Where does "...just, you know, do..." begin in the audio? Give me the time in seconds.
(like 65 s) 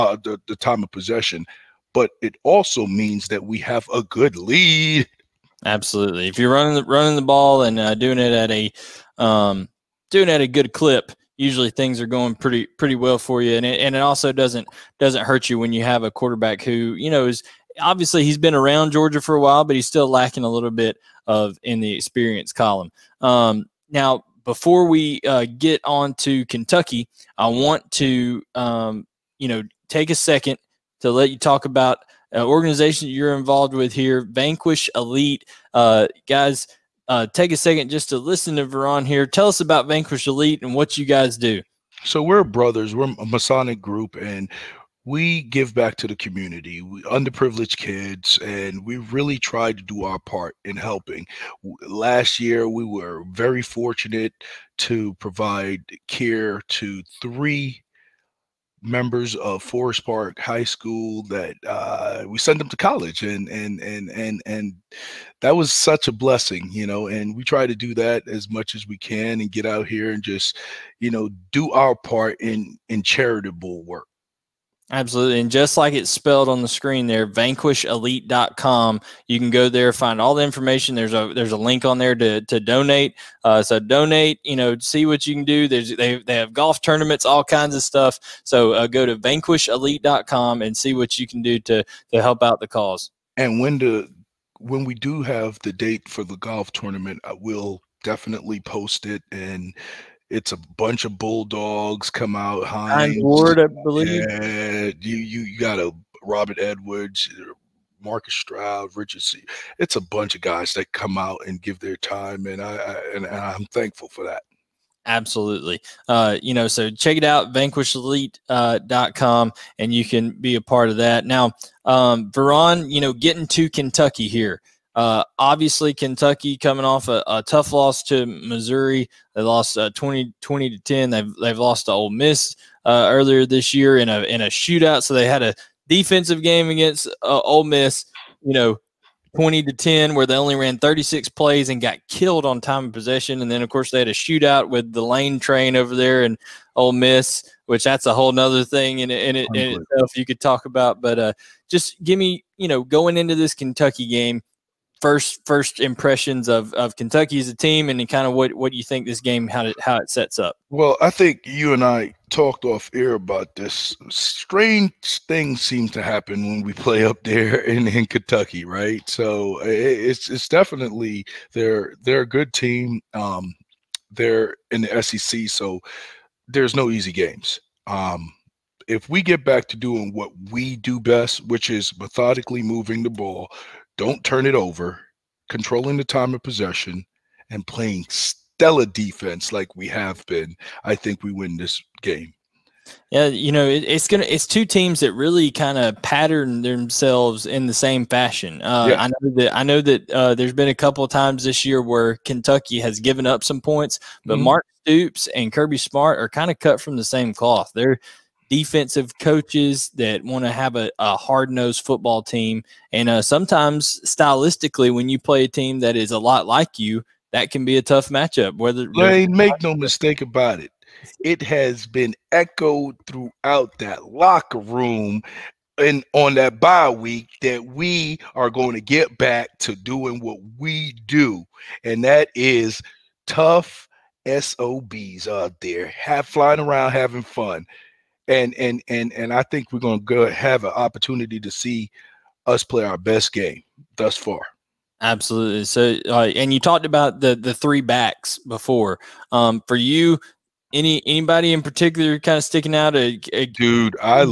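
70 s.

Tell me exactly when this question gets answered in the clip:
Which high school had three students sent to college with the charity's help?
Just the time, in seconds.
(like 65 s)
59 s.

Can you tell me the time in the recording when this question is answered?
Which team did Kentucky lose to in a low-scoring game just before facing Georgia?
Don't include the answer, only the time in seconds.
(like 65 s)
128 s.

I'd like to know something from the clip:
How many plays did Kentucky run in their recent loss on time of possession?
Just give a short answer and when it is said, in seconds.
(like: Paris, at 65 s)
36, at 140 s.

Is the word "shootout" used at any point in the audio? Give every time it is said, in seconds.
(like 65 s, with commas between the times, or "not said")
134 s, 144 s.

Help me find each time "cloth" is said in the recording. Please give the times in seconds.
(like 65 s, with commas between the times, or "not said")
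207 s.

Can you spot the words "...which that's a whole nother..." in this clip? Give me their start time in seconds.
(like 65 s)
147 s.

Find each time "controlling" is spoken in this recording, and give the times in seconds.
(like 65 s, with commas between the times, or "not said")
185 s.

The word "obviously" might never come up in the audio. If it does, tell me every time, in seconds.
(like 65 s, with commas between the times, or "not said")
17 s, 125 s.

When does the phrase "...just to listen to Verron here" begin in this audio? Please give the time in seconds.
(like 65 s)
37 s.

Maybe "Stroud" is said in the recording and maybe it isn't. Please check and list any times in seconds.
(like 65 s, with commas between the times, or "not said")
108 s.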